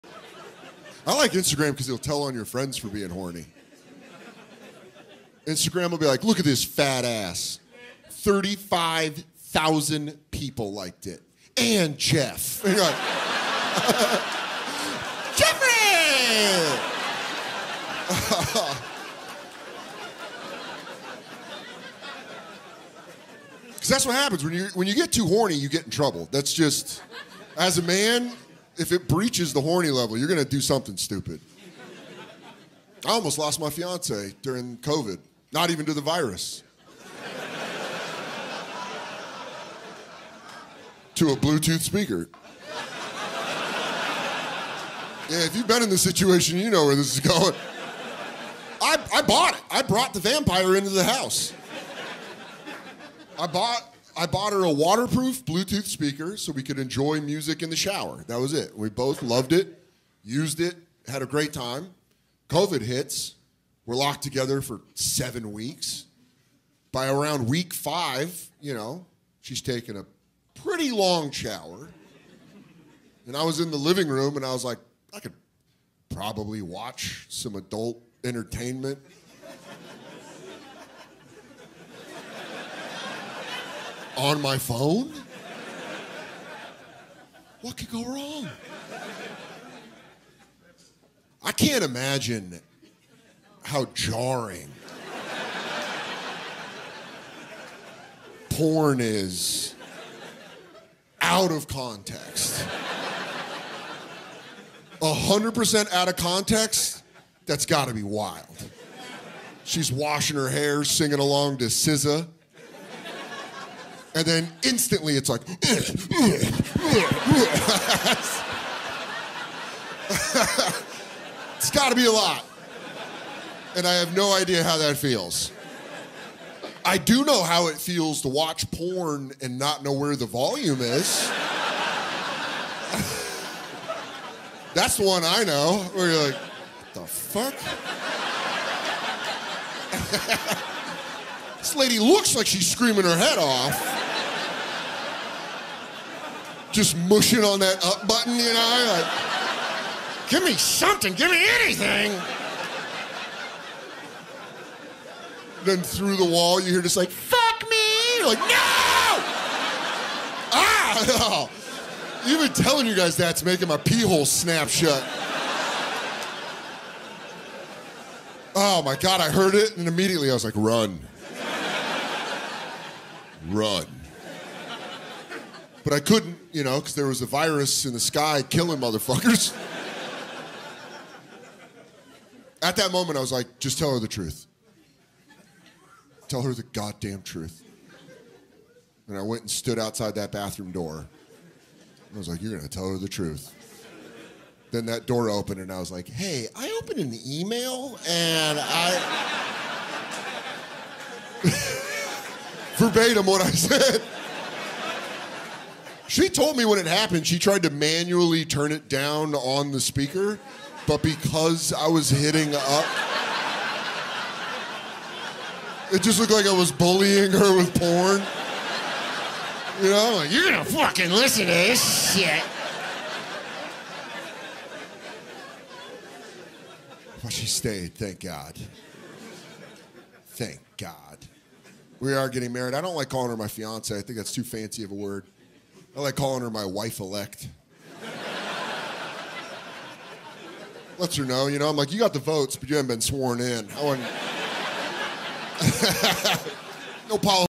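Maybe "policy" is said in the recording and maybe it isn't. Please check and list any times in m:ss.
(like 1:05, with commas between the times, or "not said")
4:07.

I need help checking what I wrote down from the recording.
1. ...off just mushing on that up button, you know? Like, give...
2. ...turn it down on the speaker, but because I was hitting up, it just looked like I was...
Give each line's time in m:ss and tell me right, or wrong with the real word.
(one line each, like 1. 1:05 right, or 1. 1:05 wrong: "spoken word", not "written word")
1. 2:23 right
2. 3:28 right.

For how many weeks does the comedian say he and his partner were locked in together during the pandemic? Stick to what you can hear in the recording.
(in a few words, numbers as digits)
7.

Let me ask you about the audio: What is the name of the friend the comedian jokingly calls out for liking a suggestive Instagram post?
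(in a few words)
Jeff.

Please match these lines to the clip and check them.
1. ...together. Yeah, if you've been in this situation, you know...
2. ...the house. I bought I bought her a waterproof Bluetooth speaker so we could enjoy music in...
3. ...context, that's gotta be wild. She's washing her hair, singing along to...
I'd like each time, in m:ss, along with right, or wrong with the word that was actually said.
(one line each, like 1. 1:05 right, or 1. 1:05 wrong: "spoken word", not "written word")
1. 0:41 wrong: "speaker", not "together"
2. 0:50 right
3. 1:46 right.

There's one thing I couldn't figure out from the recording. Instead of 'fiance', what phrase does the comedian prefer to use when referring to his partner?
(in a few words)
wife elect.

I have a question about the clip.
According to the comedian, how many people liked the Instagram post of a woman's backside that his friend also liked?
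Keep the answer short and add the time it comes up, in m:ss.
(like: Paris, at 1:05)
35,000, at 0:08.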